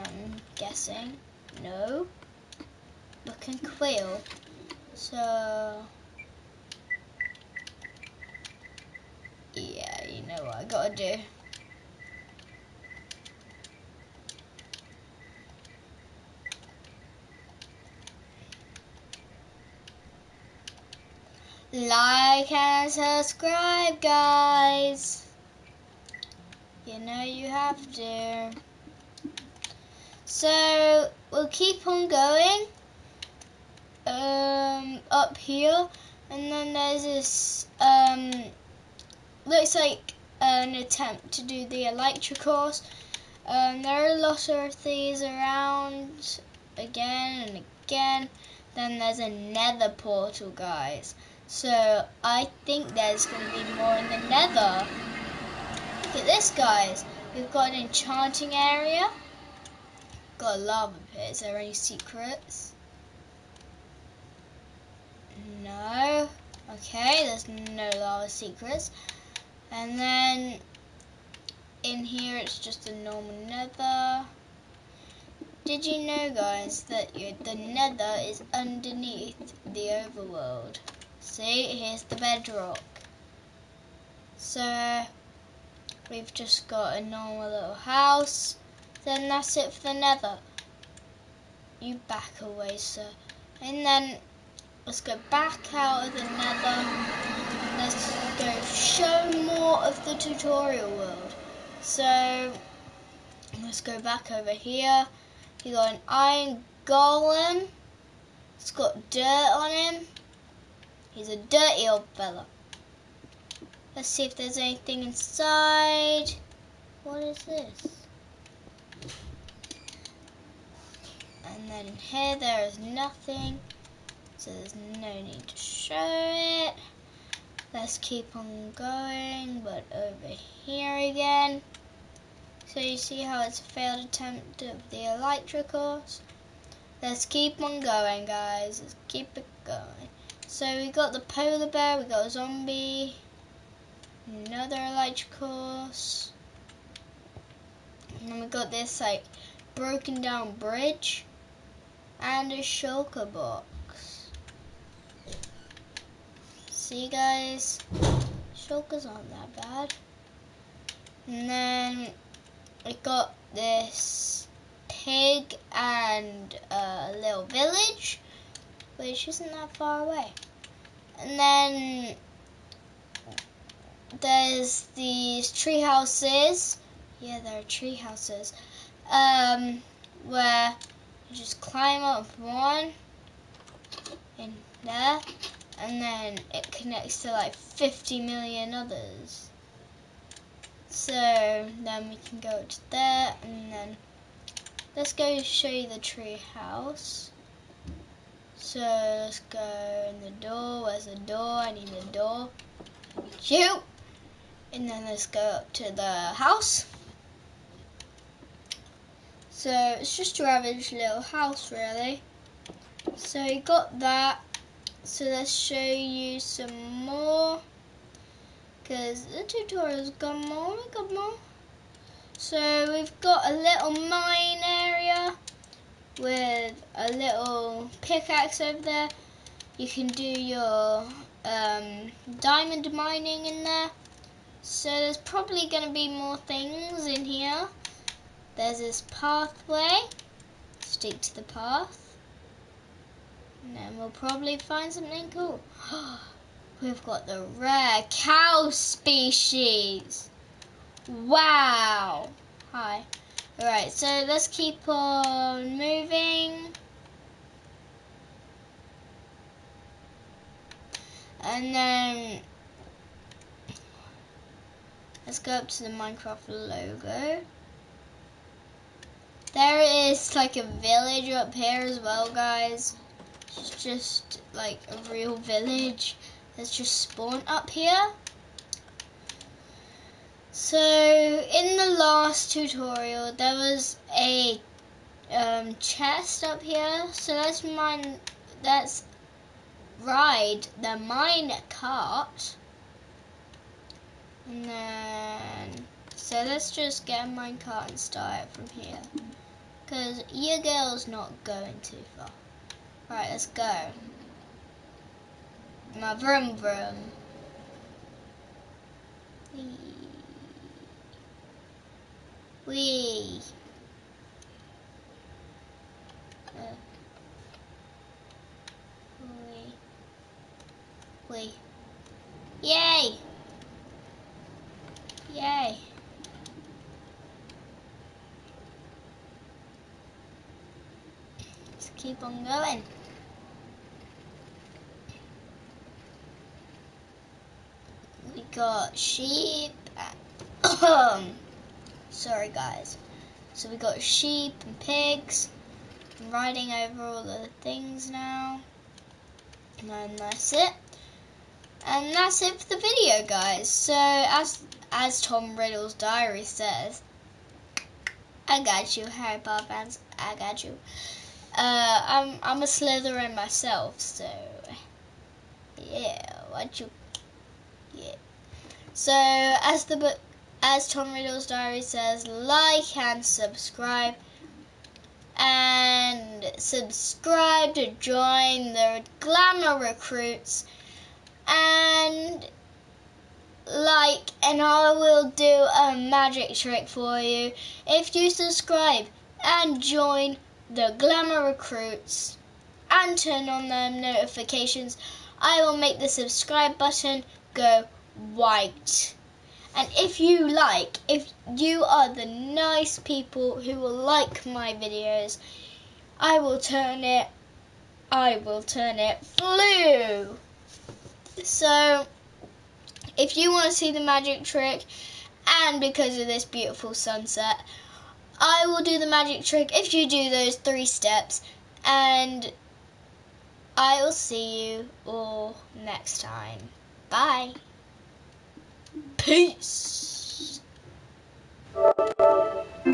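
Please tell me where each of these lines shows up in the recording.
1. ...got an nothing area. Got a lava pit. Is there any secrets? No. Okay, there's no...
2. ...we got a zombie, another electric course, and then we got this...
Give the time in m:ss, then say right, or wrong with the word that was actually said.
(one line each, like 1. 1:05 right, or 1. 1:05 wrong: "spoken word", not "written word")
1. 0:57 wrong: "enchanting", not "nothing"
2. 2:21 wrong: "horse", not "course".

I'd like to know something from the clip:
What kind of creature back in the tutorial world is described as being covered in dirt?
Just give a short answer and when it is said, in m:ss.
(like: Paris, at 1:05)
Iron golem, at 1:46.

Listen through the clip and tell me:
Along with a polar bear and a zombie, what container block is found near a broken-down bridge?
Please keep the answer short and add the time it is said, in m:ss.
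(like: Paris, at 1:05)
Shulker box, at 2:32.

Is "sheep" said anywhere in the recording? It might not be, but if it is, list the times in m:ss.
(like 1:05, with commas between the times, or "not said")
5:38, 5:44.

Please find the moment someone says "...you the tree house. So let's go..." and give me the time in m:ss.
3:15.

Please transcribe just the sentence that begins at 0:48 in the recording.
Then there's a nether portal, guys.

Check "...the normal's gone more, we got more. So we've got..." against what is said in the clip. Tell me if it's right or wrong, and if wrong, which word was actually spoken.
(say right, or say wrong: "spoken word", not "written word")
wrong: "tutorial", not "normal".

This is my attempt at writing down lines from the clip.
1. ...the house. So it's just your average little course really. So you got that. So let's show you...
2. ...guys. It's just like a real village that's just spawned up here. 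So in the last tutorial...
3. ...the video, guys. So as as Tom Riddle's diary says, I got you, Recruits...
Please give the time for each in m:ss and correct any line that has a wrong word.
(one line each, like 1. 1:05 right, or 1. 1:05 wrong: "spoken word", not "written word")
1. 3:25 wrong: "house", not "course"
2. 4:32 right
3. 5:52 wrong: "Harry", not "Recruits".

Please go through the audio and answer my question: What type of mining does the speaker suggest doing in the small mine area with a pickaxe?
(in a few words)
Diamond mining.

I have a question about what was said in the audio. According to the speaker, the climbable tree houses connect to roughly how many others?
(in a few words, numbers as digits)
50 million.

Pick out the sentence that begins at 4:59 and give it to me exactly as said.
Because your girl's not going too far.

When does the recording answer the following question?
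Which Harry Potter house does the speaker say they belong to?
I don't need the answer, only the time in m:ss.
6:02.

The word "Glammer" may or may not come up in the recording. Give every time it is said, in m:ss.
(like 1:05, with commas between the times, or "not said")
6:19, 6:30.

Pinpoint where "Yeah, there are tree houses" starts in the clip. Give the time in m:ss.
2:57.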